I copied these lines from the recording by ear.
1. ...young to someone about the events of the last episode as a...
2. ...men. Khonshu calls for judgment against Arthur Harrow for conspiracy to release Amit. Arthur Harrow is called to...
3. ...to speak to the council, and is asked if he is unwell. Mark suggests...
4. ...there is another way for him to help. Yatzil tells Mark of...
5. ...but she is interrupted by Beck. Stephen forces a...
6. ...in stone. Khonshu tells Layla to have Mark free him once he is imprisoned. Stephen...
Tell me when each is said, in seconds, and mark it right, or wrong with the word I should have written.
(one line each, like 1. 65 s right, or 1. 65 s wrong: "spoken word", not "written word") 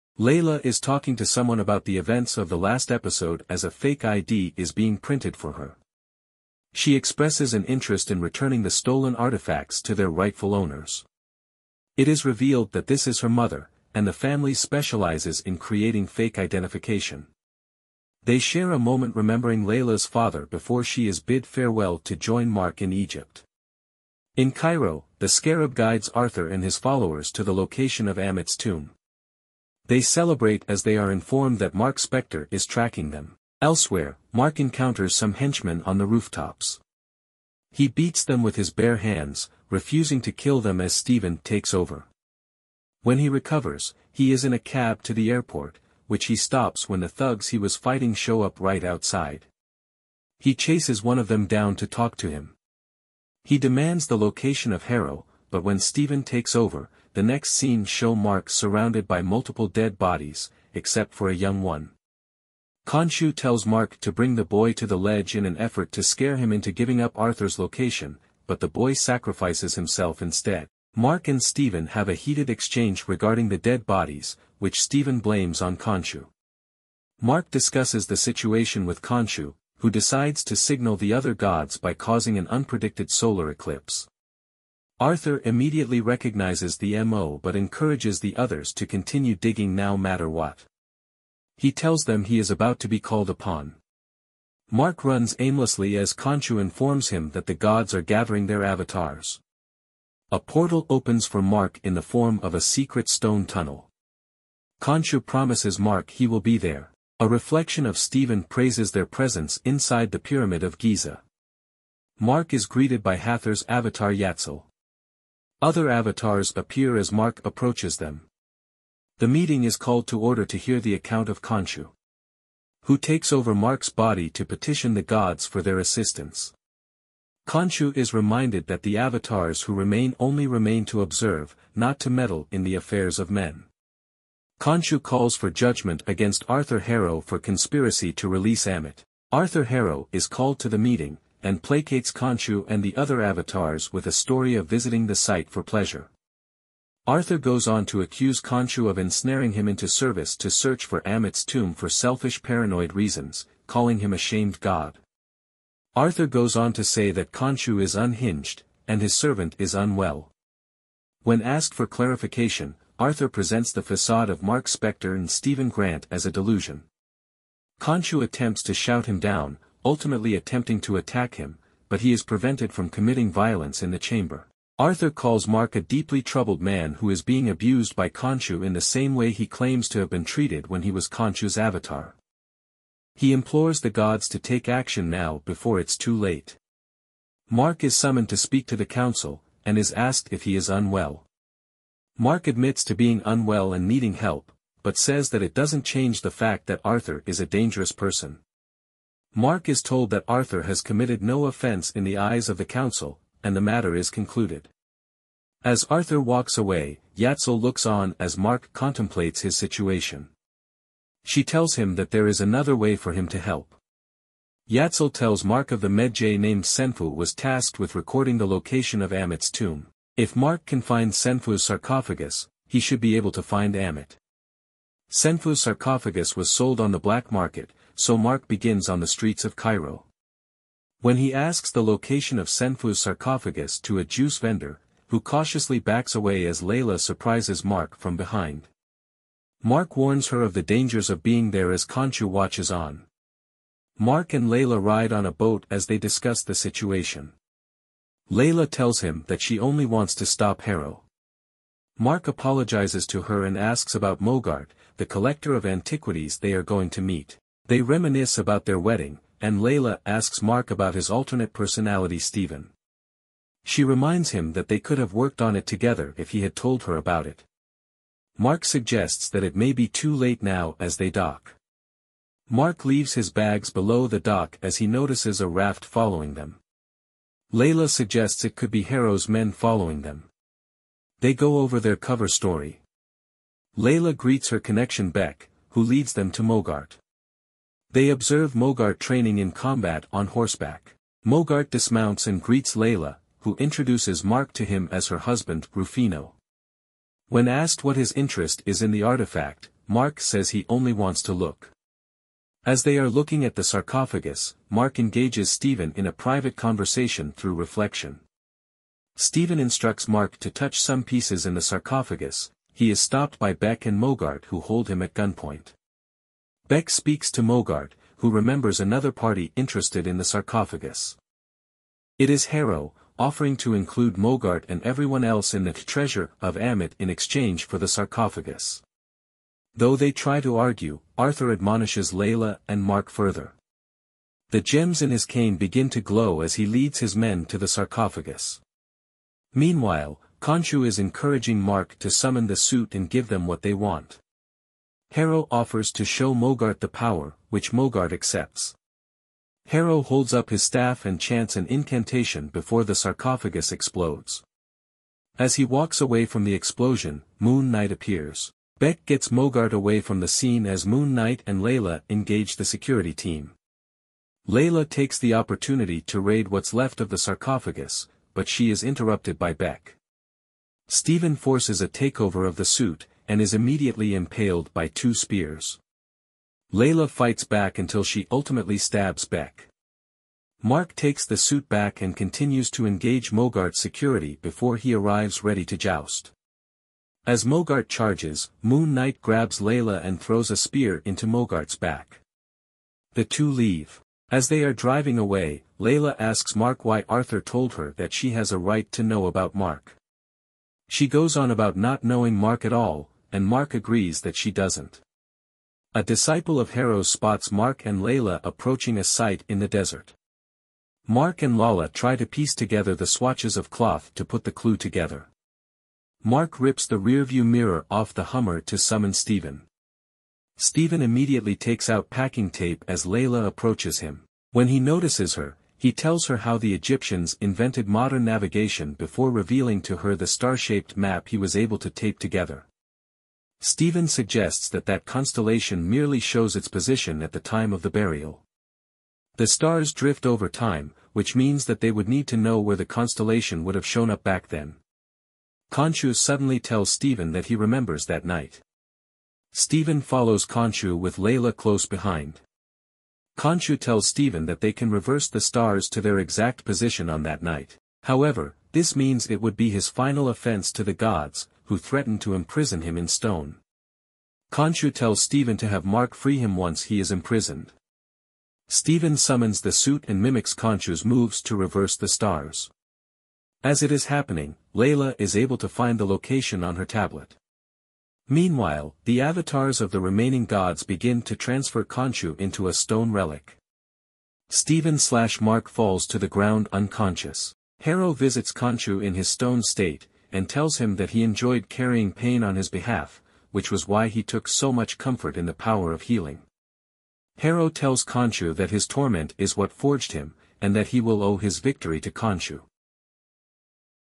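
1. 0 s wrong: "talking", not "young"
2. 133 s right
3. 188 s wrong: "admits", not "suggests"
4. 212 s right
5. 368 s right
6. 462 s wrong: "Stephen", not "Layla".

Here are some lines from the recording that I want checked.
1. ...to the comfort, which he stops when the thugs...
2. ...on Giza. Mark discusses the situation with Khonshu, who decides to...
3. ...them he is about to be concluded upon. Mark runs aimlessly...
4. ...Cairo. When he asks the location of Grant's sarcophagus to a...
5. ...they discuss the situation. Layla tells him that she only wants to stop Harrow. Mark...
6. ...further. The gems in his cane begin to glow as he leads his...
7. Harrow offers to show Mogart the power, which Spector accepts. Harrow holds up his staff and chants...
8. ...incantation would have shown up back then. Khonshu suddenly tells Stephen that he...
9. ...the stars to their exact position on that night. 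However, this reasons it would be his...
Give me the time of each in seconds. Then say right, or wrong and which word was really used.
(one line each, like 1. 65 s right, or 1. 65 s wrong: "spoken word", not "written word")
1. 45 s wrong: "airport", not "comfort"
2. 75 s wrong: "Khonshu", not "Giza"
3. 92 s wrong: "called", not "concluded"
4. 229 s wrong: "Senfu", not "Grant"
5. 245 s right
6. 333 s right
7. 345 s wrong: "Mogart", not "Spector"
8. 442 s wrong: "constellation", not "incantation"
9. 455 s wrong: "means", not "reasons".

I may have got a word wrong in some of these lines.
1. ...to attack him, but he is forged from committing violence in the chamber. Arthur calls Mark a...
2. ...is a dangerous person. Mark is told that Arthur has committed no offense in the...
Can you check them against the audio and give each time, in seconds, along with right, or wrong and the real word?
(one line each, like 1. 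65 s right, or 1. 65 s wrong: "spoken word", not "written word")
1. 170 s wrong: "prevented", not "forged"
2. 197 s right.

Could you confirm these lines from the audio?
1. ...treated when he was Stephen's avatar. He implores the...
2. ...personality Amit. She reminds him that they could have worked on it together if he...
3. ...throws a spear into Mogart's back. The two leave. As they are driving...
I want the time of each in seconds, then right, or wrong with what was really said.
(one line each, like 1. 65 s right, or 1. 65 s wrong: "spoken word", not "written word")
1. 180 s wrong: "Khonshu", not "Stephen"
2. 261 s wrong: "Stephen", not "Amit"
3. 390 s right.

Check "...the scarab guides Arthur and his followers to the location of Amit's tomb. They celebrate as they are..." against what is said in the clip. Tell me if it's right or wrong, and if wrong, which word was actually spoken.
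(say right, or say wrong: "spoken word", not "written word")
right.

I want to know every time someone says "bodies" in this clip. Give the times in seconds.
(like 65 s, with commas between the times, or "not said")
59 s, 73 s.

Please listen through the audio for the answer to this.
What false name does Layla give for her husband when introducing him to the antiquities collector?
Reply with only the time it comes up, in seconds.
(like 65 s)
295 s.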